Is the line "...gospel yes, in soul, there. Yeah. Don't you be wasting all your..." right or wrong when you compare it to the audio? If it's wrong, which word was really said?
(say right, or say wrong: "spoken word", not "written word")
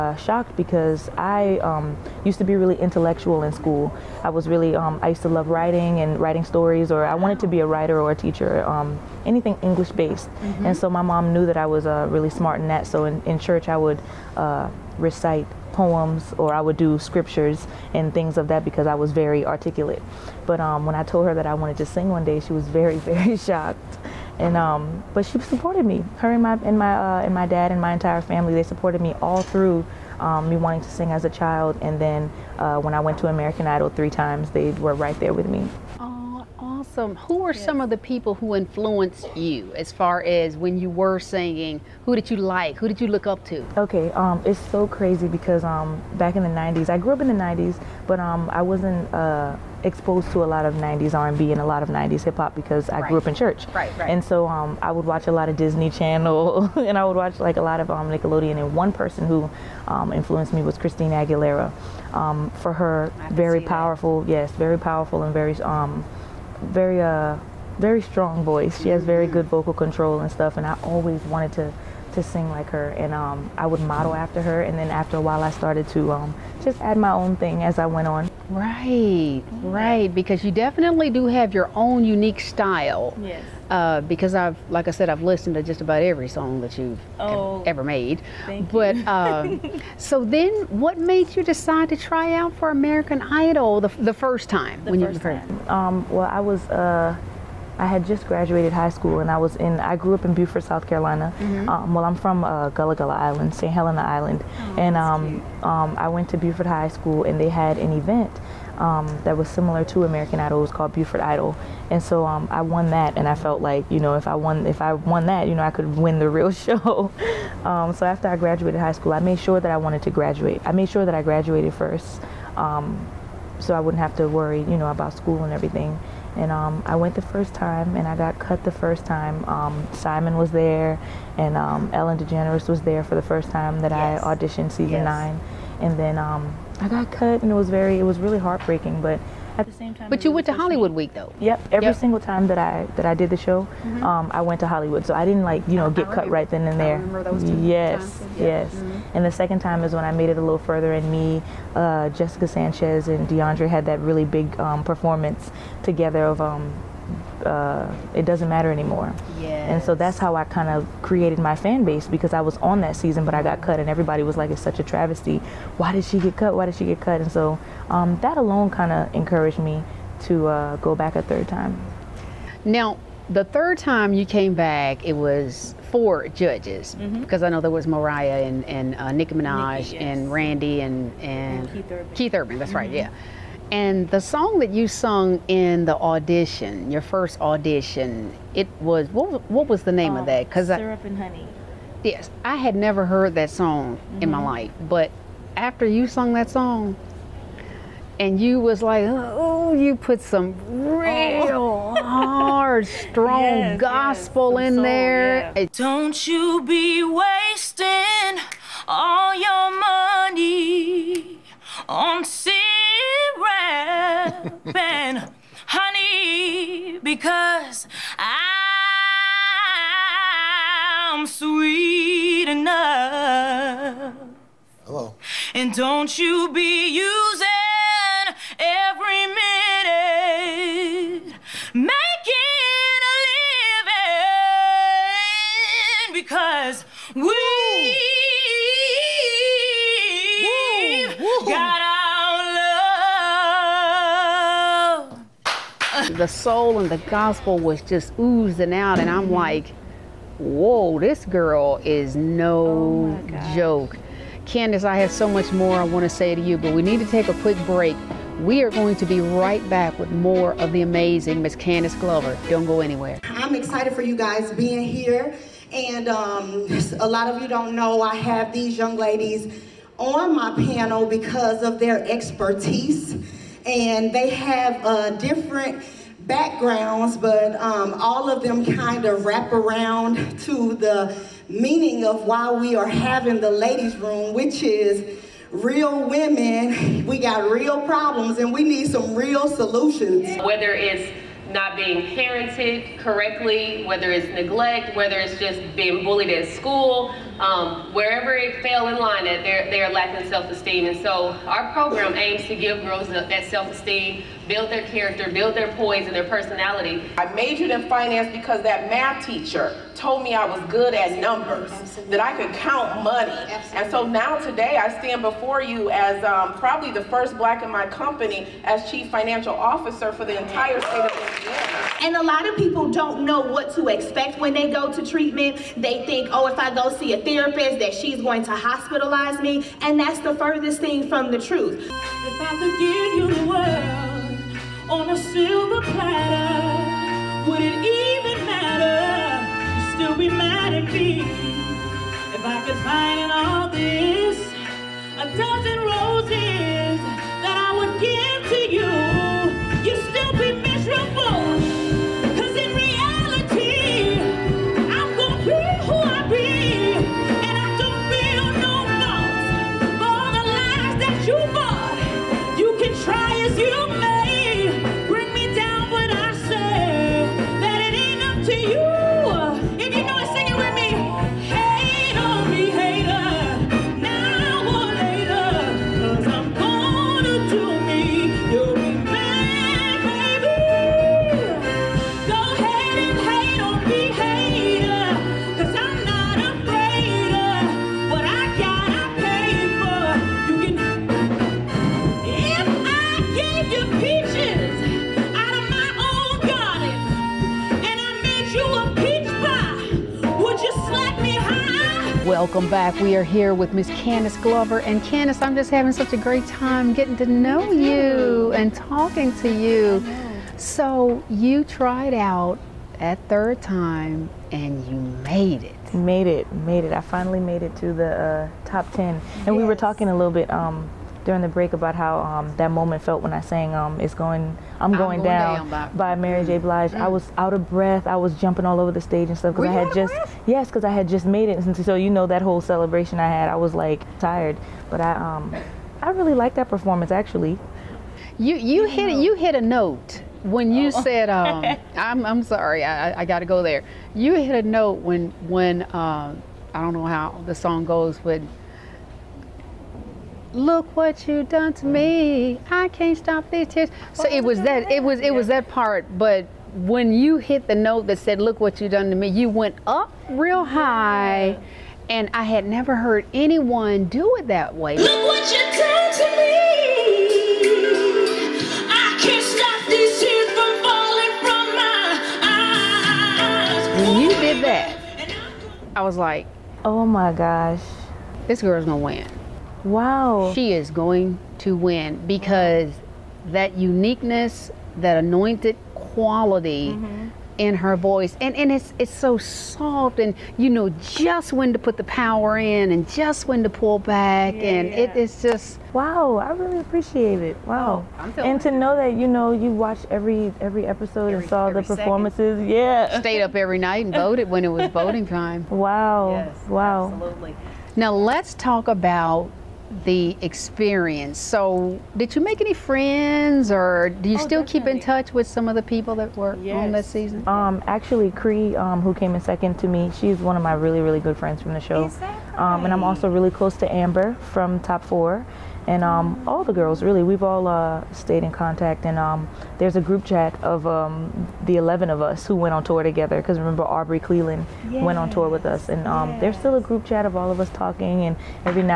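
right.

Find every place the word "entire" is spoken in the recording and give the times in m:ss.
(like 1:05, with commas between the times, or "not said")
0:27, 5:20.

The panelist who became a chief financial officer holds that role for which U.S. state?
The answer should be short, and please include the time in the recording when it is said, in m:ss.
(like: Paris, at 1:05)
Indiana, at 5:21.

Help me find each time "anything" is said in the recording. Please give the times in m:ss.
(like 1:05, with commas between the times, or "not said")
0:09.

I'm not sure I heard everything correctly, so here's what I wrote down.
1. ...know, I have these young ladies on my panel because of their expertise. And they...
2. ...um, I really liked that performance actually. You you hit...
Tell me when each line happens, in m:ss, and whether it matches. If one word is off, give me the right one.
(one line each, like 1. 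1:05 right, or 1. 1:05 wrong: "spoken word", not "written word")
1. 4:27 right
2. 7:15 right.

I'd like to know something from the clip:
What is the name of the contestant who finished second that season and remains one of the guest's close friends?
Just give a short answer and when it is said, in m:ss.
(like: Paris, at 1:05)
Kree, at 8:38.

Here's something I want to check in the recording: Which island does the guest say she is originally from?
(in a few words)
St. Helena Island.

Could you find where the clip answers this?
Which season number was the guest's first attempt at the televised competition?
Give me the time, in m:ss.
2:15.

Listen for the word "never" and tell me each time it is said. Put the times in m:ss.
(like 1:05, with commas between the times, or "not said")
3:12, 7:42.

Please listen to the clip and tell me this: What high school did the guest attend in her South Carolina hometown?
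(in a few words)
Beaufort High School.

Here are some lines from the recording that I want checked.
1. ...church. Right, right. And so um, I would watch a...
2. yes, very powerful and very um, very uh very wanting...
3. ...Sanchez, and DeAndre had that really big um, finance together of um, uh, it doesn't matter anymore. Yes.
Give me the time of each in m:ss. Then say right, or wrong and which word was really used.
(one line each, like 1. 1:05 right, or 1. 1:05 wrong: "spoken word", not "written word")
1. 0:53 right
2. 1:04 wrong: "strong", not "wanting"
3. 2:32 wrong: "performance", not "finance".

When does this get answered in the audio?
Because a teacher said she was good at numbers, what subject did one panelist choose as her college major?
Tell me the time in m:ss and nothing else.
5:07.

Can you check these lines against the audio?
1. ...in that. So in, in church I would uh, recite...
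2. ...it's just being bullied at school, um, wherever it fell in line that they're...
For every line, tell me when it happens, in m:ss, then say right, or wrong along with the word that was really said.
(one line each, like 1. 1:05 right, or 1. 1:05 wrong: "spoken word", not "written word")
1. 0:12 right
2. 4:55 right.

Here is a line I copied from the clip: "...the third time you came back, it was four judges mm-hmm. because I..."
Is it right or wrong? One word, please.
right.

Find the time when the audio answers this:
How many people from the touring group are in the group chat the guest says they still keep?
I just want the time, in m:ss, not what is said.
8:51.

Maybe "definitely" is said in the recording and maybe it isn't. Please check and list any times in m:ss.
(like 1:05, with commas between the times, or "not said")
1:20, 8:34.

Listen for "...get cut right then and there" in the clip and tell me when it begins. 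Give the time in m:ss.
2:25.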